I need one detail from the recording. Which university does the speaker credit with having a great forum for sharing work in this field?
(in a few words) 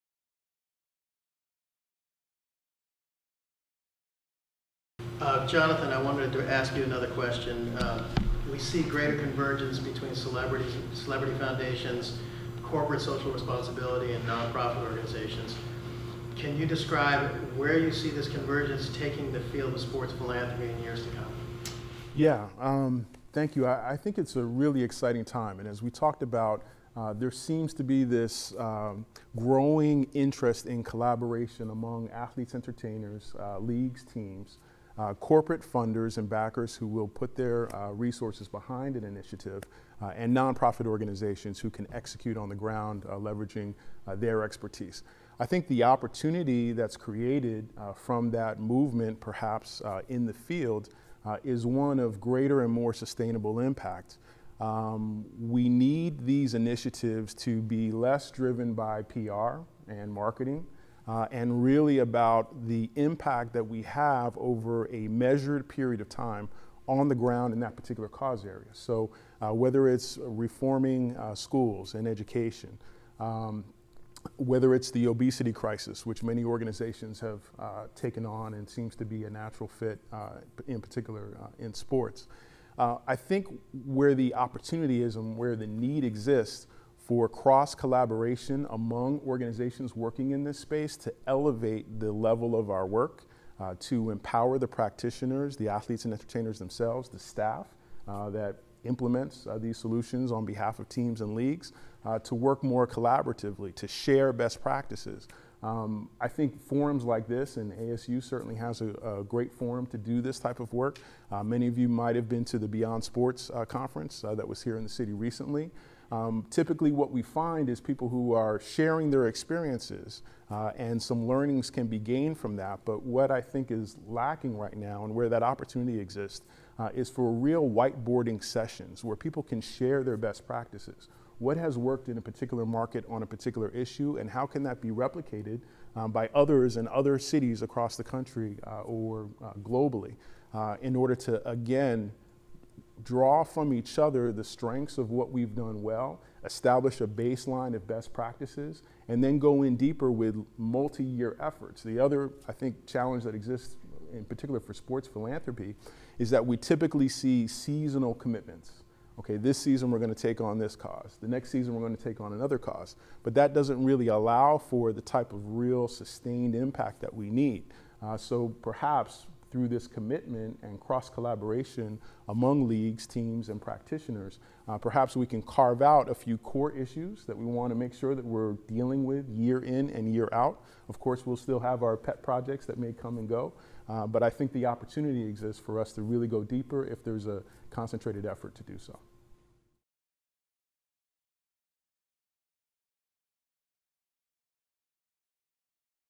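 ASU.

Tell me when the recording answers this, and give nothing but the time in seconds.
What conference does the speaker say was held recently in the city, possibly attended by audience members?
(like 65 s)
112 s.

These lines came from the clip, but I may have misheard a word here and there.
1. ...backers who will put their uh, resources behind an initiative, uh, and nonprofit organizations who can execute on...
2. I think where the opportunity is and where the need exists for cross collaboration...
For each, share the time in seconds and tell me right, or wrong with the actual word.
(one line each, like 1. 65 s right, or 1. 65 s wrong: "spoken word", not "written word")
1. 36 s right
2. 83 s right.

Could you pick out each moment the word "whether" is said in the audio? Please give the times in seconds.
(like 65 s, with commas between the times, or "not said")
69 s, 74 s.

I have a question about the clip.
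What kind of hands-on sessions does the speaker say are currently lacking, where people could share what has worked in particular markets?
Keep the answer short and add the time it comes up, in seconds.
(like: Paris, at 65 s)
whiteboarding sessions, at 127 s.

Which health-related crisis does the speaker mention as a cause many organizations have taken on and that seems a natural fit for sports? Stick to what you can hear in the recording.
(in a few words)
obesity crisis.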